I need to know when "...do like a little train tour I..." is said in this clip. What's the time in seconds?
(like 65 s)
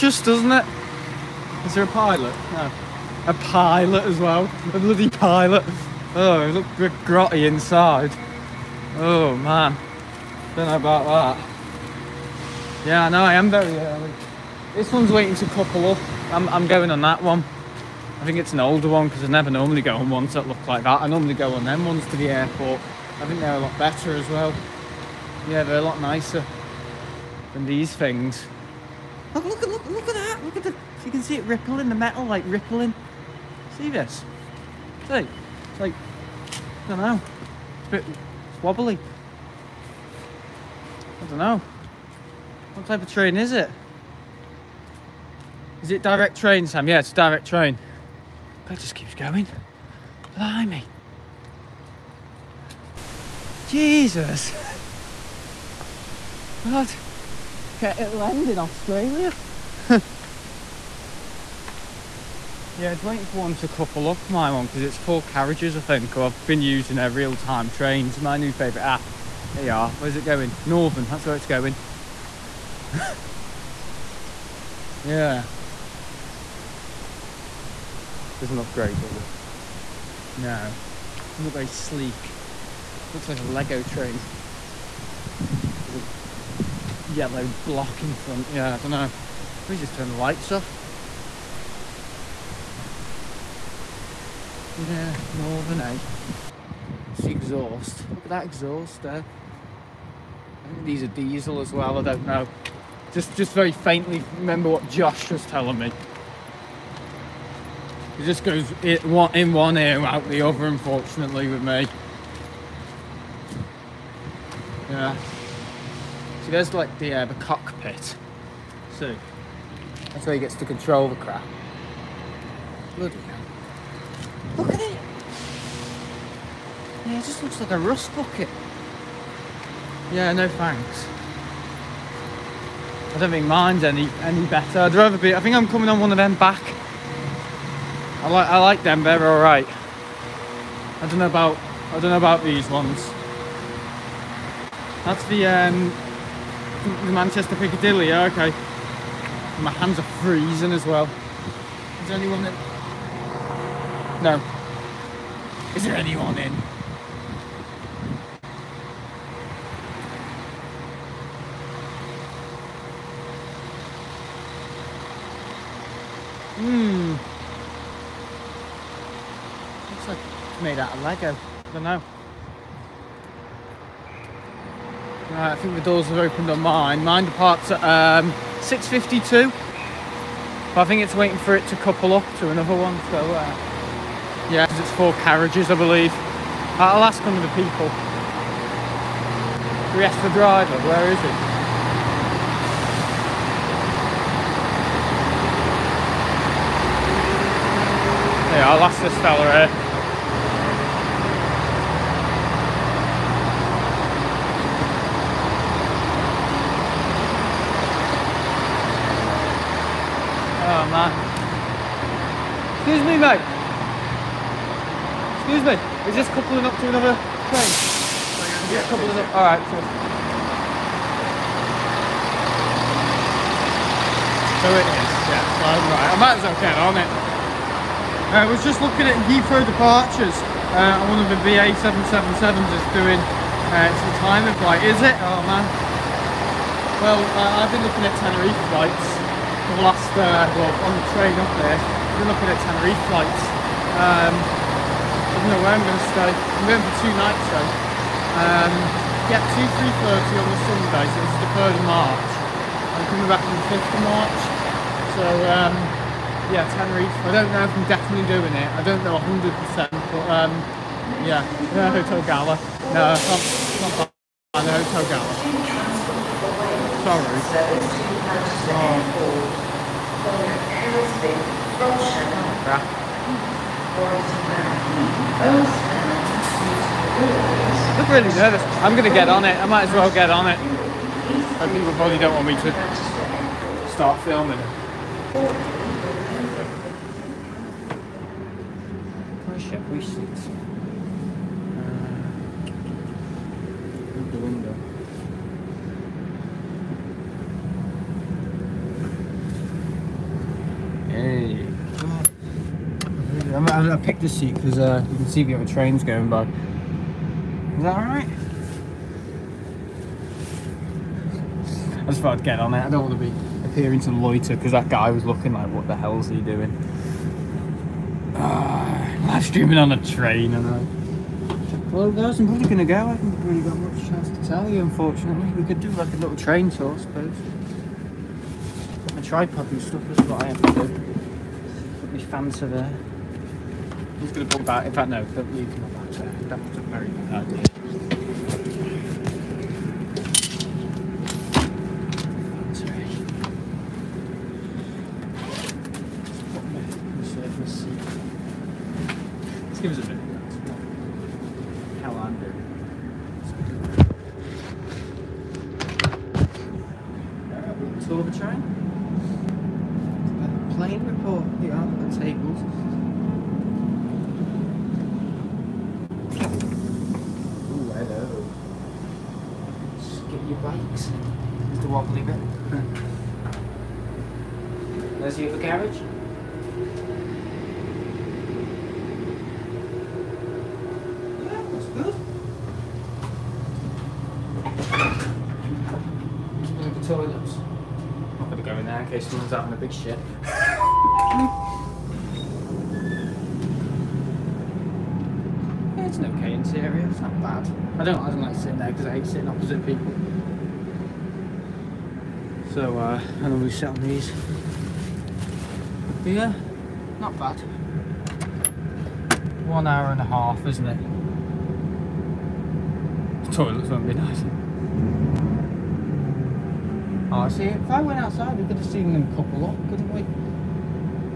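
325 s.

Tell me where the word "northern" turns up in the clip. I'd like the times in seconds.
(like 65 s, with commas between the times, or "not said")
70 s, 95 s.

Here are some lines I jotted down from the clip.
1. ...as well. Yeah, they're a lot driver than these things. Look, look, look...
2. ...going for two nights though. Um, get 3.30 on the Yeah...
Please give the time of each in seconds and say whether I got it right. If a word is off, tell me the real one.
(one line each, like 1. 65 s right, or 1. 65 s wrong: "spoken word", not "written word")
1. 24 s wrong: "nicer", not "driver"
2. 246 s wrong: "Sunday", not "Yeah".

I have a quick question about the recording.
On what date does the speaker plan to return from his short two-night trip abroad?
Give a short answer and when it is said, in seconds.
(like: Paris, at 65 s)
5th of March, at 253 s.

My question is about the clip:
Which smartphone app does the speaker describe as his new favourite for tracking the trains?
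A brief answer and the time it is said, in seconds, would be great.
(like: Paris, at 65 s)
Real Time Trains, at 67 s.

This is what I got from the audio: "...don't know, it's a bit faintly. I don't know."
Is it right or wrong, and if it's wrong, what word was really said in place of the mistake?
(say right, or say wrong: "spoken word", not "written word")
wrong: "wobbly", not "faintly".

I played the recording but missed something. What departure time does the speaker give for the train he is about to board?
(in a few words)
6.52.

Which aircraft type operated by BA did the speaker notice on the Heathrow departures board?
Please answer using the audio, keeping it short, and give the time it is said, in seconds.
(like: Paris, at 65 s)
777, at 231 s.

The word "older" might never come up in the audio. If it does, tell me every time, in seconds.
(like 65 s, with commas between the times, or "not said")
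18 s.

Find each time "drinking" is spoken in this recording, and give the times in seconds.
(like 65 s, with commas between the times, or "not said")
not said.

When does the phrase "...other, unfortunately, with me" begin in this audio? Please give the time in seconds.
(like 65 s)
110 s.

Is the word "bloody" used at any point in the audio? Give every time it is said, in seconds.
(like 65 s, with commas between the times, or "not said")
4 s, 122 s.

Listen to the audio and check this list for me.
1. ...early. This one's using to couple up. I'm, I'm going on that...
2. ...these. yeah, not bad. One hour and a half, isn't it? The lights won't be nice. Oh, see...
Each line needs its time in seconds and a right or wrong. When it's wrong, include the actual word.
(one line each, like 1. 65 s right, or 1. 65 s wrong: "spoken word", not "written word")
1. 13 s wrong: "waiting", not "using"
2. 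403 s wrong: "toilets", not "lights".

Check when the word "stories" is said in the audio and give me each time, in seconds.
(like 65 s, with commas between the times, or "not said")
not said.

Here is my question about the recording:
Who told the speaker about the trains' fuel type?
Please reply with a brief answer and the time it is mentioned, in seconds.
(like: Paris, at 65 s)
Josh, at 104 s.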